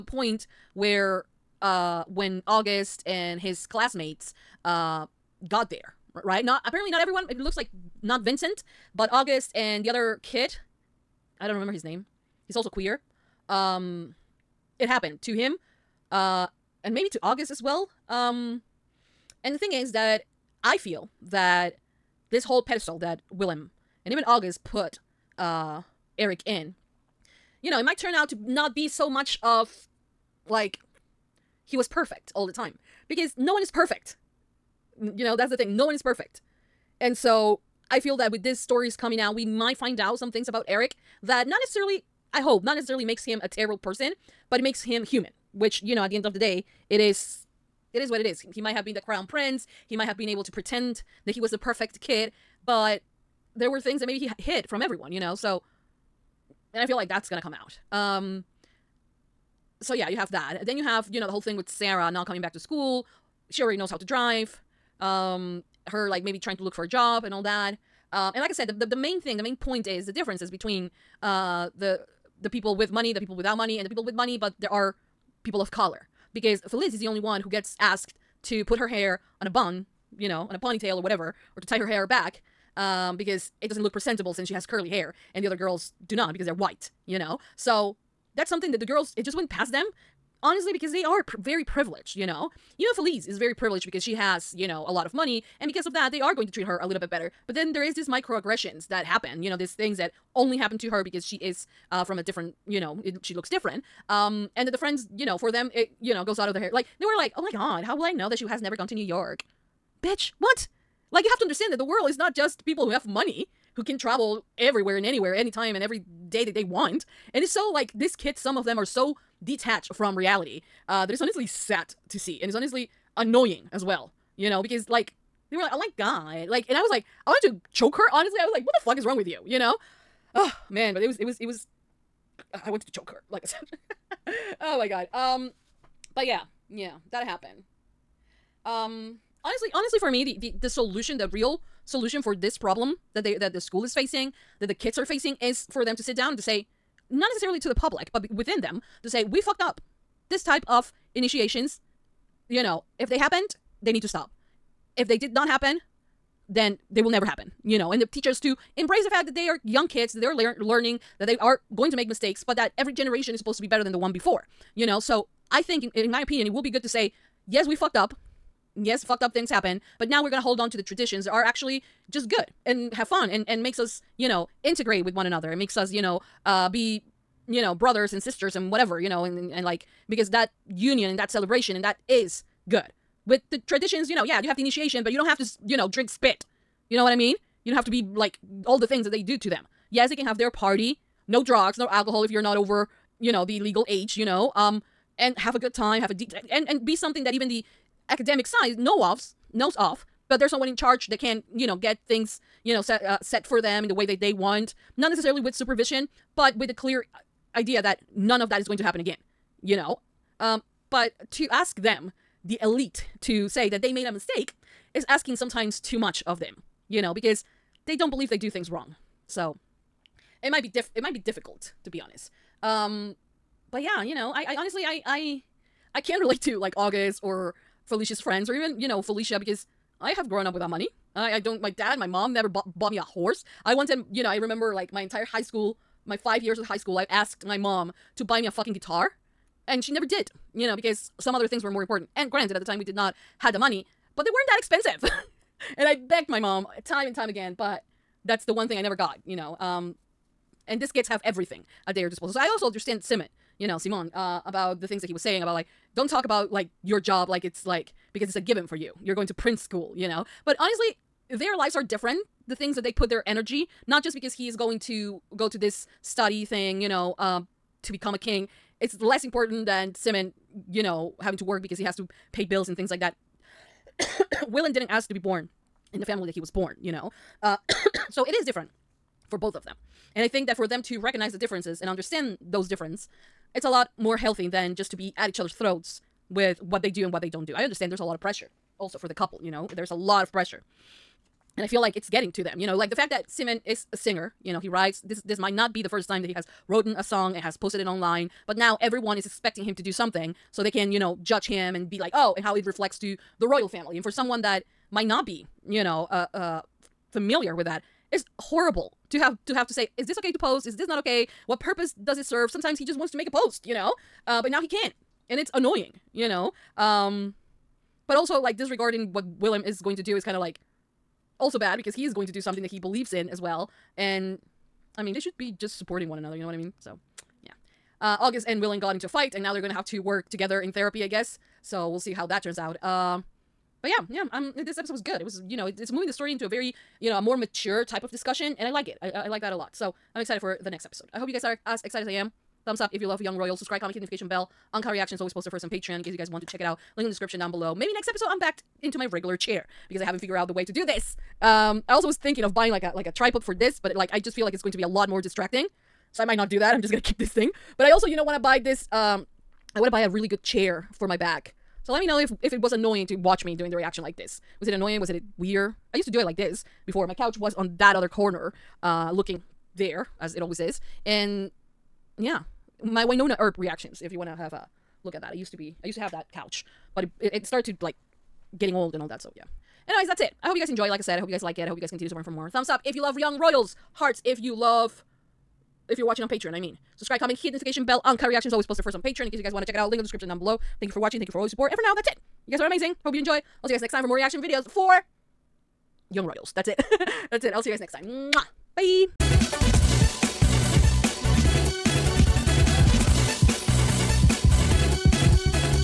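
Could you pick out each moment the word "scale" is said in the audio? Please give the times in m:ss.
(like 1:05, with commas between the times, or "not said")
not said.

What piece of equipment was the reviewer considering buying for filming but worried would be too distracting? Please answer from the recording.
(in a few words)
Tripod.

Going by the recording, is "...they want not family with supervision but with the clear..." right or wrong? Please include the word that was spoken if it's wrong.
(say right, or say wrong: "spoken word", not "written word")
wrong: "necessarily", not "family".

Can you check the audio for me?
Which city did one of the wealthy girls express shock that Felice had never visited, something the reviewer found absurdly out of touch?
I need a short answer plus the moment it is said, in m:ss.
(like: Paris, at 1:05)
New York, at 1:48.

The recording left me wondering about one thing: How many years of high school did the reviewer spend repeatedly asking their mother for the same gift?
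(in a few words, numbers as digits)
5.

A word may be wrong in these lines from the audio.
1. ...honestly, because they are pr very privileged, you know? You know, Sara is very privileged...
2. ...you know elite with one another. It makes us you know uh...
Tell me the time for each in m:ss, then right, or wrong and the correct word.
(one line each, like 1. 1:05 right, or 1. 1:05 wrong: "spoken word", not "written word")
1. 1:30 wrong: "Felice", not "Sara"
2. 2:54 wrong: "integrate", not "elite".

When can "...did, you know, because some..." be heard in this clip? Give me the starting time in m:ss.
4:00.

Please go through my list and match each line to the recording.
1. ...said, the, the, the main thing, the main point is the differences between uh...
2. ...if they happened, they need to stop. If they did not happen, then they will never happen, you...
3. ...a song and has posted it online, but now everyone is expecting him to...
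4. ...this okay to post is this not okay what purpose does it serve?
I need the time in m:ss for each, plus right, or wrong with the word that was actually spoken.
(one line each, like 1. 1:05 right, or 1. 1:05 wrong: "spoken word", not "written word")
1. 1:08 right
2. 2:32 right
3. 4:56 right
4. 5:10 right.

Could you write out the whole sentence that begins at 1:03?
She already knows how to drive.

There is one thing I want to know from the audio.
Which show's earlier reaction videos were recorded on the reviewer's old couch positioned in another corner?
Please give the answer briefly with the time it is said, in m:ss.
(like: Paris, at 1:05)
Wynonna Earp, at 6:13.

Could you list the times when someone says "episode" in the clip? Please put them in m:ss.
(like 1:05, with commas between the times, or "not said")
5:34, 5:40, 5:48.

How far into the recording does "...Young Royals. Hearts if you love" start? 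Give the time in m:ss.
6:23.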